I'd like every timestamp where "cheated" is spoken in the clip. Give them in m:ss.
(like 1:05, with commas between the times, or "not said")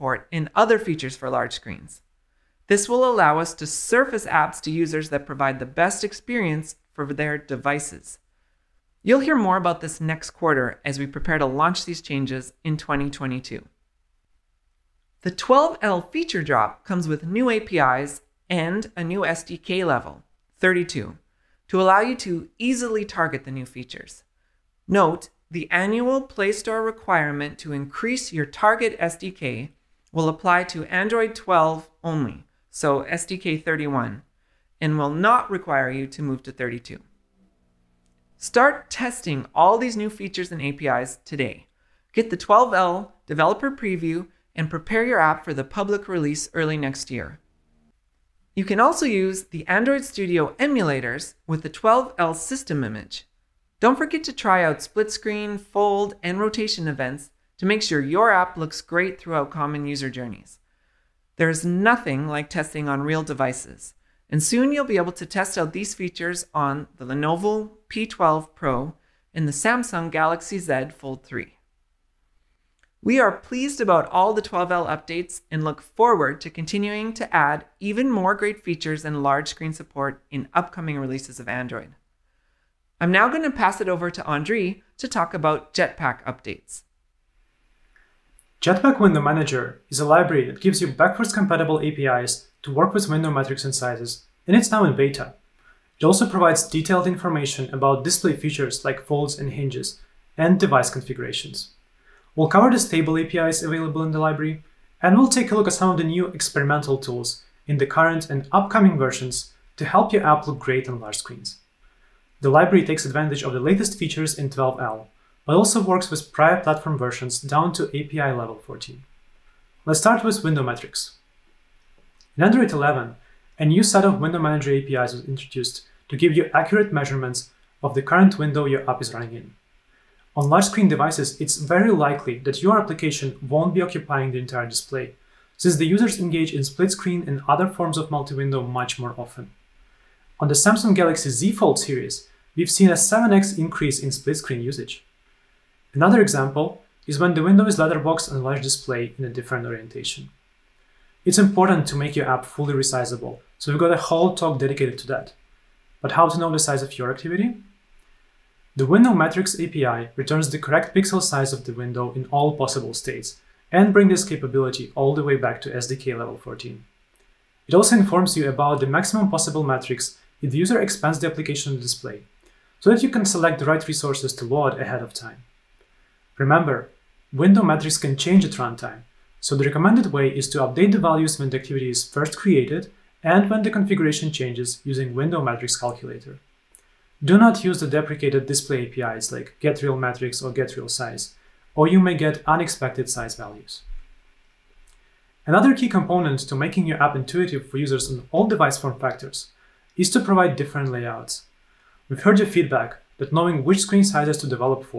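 not said.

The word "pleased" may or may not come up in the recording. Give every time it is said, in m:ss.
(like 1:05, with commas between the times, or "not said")
1:13.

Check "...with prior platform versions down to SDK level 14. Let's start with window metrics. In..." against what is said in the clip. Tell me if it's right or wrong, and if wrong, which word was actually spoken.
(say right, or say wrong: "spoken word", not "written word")
wrong: "API", not "SDK".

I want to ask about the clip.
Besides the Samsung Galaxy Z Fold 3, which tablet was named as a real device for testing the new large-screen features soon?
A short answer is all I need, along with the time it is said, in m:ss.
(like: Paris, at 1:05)
Lenovo P12 Pro, at 1:07.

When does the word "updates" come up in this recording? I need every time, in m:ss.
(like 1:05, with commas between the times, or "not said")
1:14, 1:26, 3:00.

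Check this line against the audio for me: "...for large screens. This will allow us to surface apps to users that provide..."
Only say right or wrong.
right.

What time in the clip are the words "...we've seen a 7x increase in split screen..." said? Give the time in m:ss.
2:22.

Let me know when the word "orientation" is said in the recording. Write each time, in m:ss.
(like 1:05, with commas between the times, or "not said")
2:29.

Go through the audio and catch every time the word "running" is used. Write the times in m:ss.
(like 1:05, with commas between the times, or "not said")
2:09.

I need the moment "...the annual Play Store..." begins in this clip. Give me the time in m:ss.
0:25.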